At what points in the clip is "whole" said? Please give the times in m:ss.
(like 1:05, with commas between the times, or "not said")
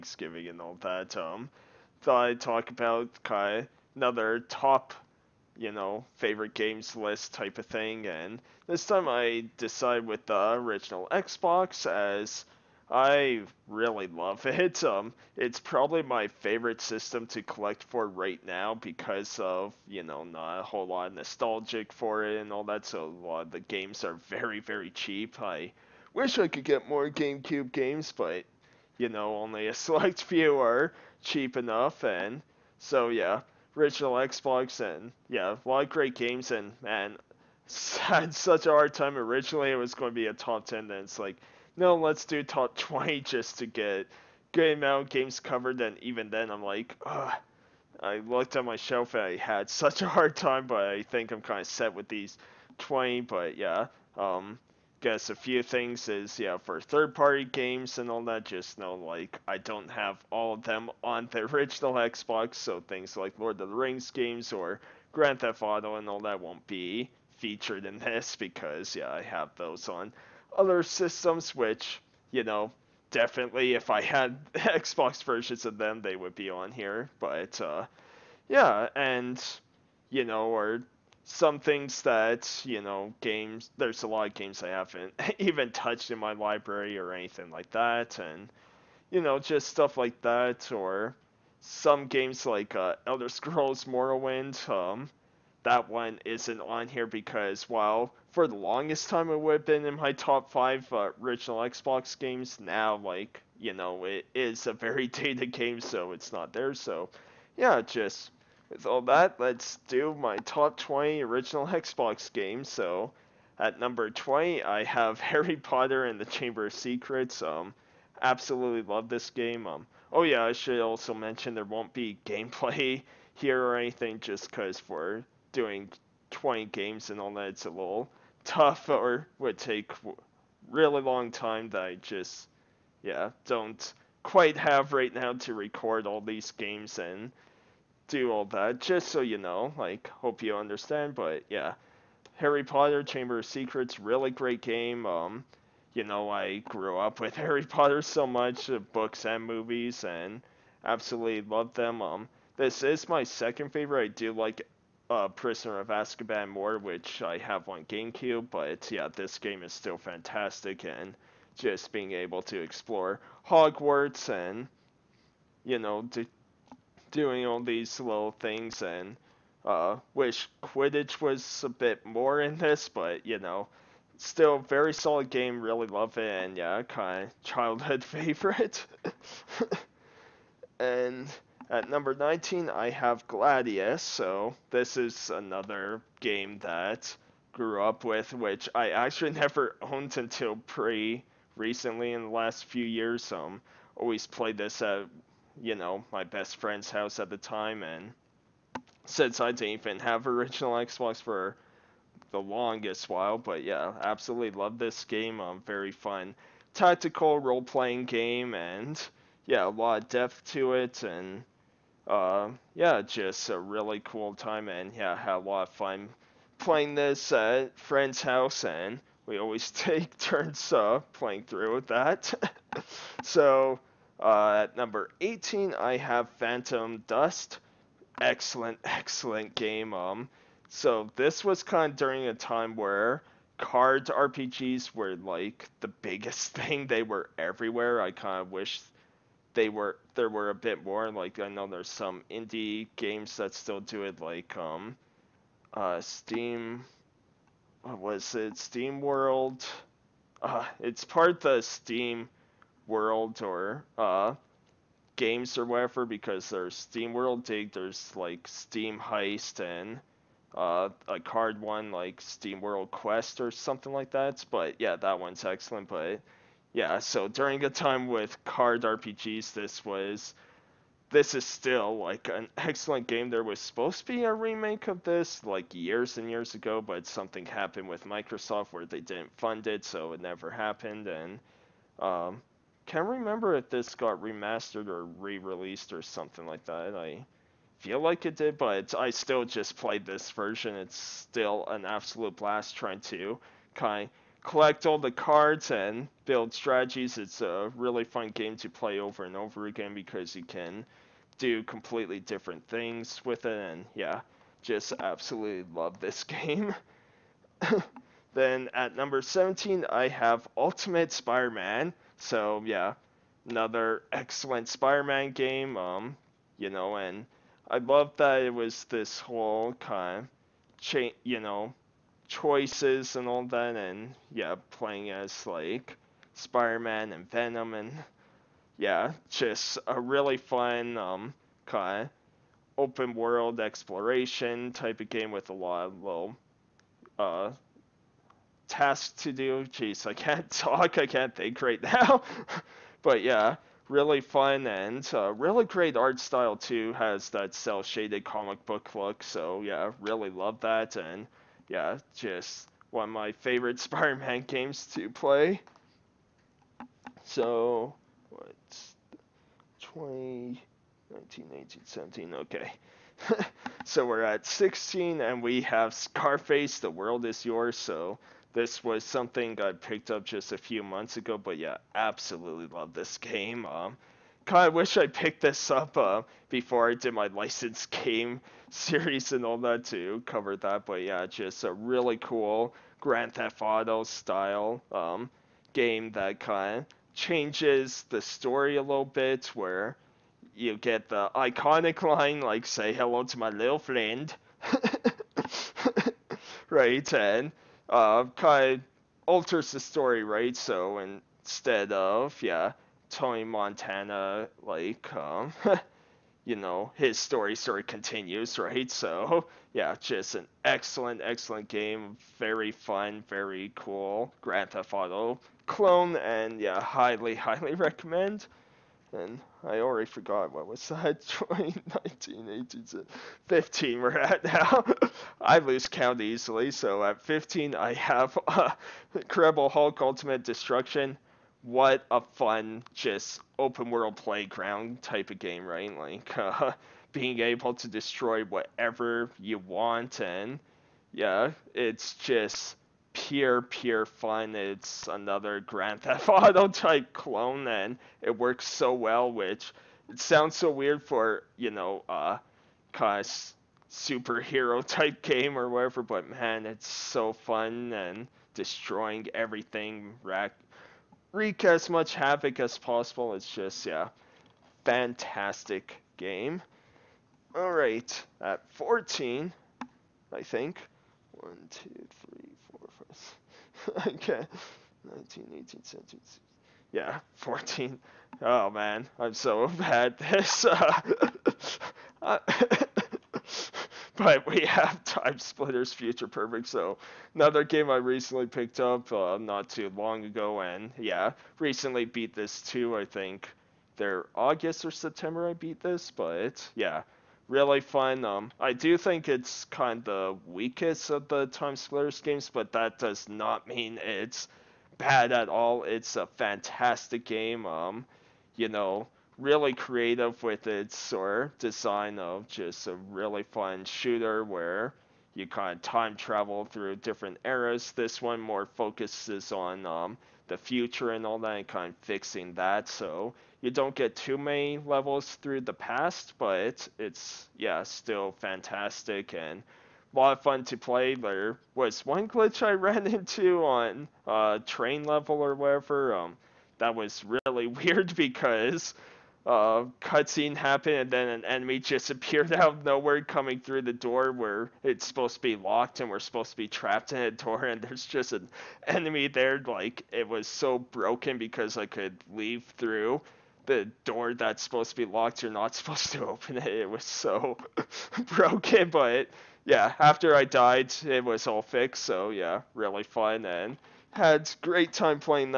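0:20, 5:19.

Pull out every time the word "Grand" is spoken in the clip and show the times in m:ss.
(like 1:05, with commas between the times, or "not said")
1:05, 6:23, 6:54, 7:25.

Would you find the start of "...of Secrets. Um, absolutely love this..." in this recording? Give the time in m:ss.
1:56.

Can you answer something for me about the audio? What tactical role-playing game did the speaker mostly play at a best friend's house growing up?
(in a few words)
Gladius.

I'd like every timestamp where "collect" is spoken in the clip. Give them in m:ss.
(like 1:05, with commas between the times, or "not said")
0:17, 4:54.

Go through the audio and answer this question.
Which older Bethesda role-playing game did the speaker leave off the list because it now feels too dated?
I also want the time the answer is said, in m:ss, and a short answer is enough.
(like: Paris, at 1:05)
Elder Scrolls Morrowind, at 1:33.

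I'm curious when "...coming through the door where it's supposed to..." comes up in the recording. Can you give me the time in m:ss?
9:03.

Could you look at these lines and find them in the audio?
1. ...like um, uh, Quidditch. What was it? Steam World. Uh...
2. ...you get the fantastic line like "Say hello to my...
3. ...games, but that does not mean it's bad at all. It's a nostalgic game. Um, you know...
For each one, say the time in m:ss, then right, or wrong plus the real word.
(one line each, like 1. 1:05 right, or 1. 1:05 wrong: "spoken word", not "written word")
1. 4:04 wrong: "Steam", not "Quidditch"
2. 6:30 wrong: "iconic", not "fantastic"
3. 8:22 wrong: "fantastic", not "nostalgic".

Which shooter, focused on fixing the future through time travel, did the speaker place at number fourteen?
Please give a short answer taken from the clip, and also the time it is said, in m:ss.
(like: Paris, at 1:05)
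Time Splitters Future Perfect, at 8:05.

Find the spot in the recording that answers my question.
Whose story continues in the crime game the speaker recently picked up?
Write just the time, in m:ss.
6:43.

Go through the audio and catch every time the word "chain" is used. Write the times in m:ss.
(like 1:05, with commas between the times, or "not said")
5:20.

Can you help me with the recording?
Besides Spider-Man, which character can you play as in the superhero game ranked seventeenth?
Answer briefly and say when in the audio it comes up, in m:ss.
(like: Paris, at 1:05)
Venom, at 5:27.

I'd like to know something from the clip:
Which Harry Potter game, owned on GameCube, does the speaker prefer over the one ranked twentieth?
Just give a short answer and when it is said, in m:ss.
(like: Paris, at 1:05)
Prisoner of Azkaban, at 2:35.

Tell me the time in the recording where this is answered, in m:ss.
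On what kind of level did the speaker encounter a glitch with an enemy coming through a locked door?
8:54.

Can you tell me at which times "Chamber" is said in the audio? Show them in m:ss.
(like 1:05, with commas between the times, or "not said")
1:56, 2:23.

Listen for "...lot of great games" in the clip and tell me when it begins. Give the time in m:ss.
0:35.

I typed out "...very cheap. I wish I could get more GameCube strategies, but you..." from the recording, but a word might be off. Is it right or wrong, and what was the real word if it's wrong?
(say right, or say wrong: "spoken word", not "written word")
wrong: "games", not "strategies".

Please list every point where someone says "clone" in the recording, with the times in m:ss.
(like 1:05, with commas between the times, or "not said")
6:55, 7:27.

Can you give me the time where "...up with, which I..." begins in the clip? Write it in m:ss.
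3:07.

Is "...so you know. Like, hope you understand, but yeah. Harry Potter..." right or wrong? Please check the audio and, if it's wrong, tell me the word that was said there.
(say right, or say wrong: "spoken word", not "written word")
right.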